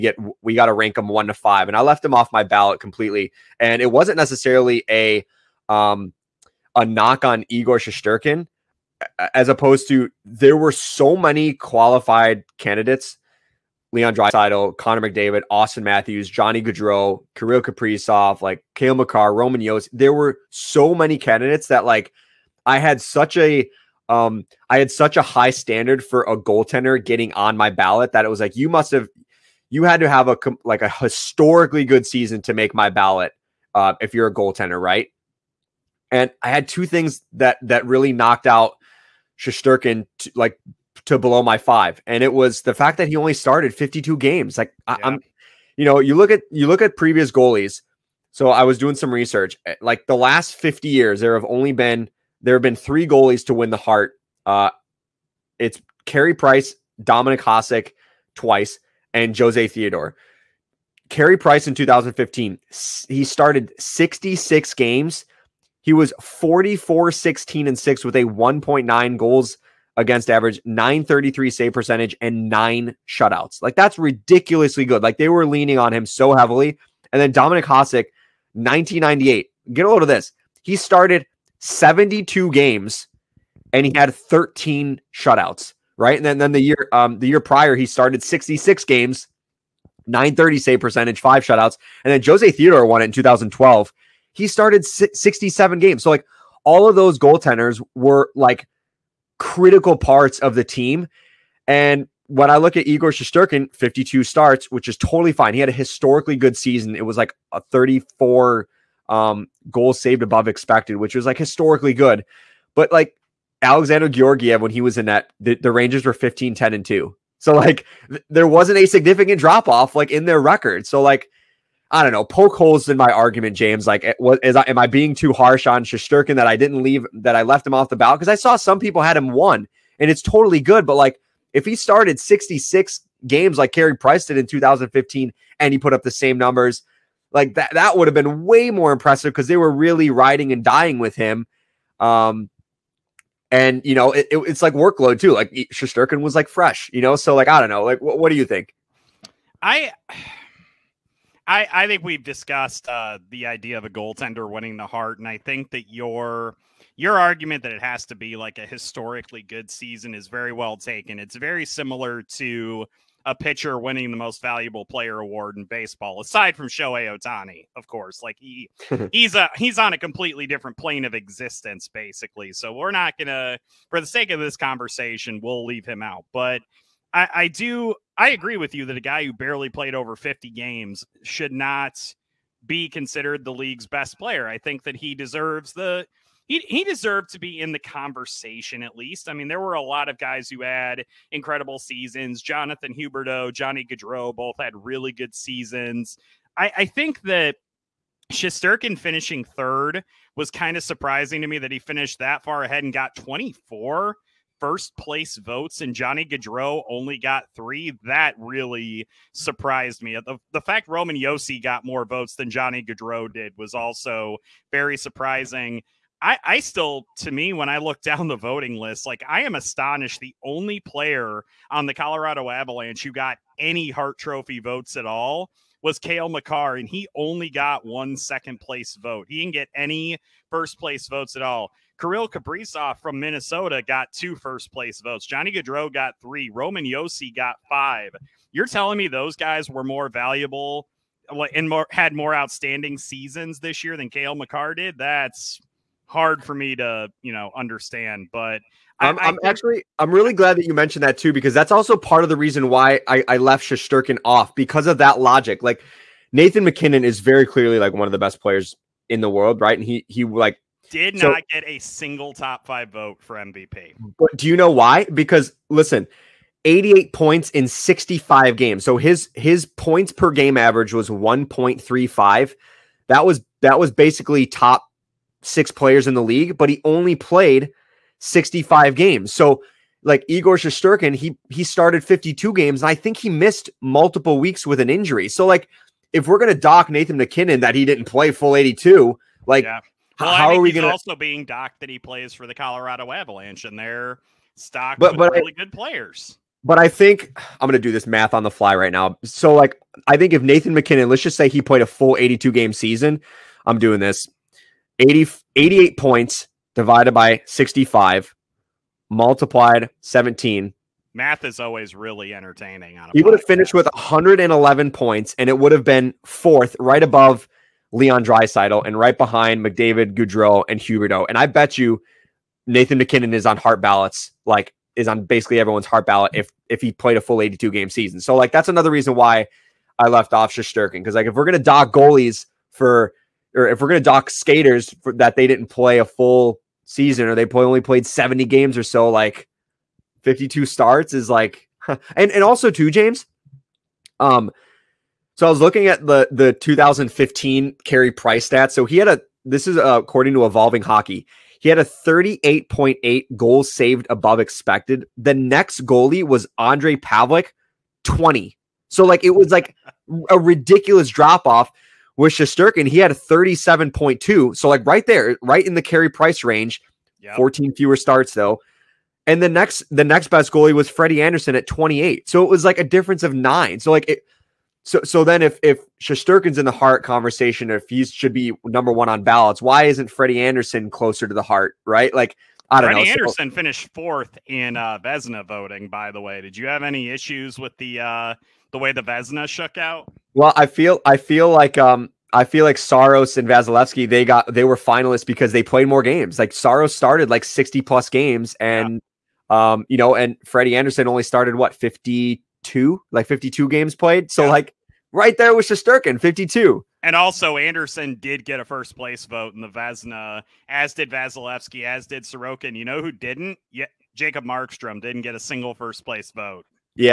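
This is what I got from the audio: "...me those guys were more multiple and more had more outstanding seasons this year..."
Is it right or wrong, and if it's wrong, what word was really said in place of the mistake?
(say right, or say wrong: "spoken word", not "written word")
wrong: "valuable", not "multiple".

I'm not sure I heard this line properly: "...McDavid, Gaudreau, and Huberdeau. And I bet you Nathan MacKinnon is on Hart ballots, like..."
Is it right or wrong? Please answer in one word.
right.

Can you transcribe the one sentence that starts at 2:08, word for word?
Because I saw some people had him one, and it's totally good.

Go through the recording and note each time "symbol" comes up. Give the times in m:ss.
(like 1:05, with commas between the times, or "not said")
not said.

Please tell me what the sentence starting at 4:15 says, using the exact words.
Like Nathan MacKinnon is very clearly like one of the best players in the world, right?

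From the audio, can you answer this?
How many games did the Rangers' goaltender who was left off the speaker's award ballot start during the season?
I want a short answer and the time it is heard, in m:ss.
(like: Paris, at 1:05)
52, at 0:43.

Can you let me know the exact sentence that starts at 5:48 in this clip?
So he had a this is uh, according to Evolving Hockey.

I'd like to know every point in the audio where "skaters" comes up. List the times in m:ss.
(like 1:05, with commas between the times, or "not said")
5:34.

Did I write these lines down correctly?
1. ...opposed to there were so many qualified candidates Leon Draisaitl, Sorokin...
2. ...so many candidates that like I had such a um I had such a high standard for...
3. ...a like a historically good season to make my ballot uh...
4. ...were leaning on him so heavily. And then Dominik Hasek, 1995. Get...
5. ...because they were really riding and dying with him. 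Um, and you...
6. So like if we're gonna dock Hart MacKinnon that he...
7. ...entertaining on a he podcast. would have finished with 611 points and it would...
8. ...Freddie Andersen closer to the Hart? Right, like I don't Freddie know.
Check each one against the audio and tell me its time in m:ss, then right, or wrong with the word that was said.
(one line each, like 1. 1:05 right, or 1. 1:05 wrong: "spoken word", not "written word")
1. 0:09 wrong: "Connor", not "Sorokin"
2. 0:20 right
3. 0:30 right
4. 1:15 wrong: "1998", not "1995"
5. 2:19 right
6. 4:45 wrong: "Nathan", not "Hart"
7. 5:12 wrong: "111", not "611"
8. 6:20 right.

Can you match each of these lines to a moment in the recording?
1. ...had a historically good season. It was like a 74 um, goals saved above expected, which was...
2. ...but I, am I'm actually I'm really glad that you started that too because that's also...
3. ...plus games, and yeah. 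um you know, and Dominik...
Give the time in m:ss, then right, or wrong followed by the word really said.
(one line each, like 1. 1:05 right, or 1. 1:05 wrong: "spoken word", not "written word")
1. 1:45 wrong: "34", not "74"
2. 4:08 wrong: "mentioned", not "started"
3. 6:37 wrong: "Freddie", not "Dominik".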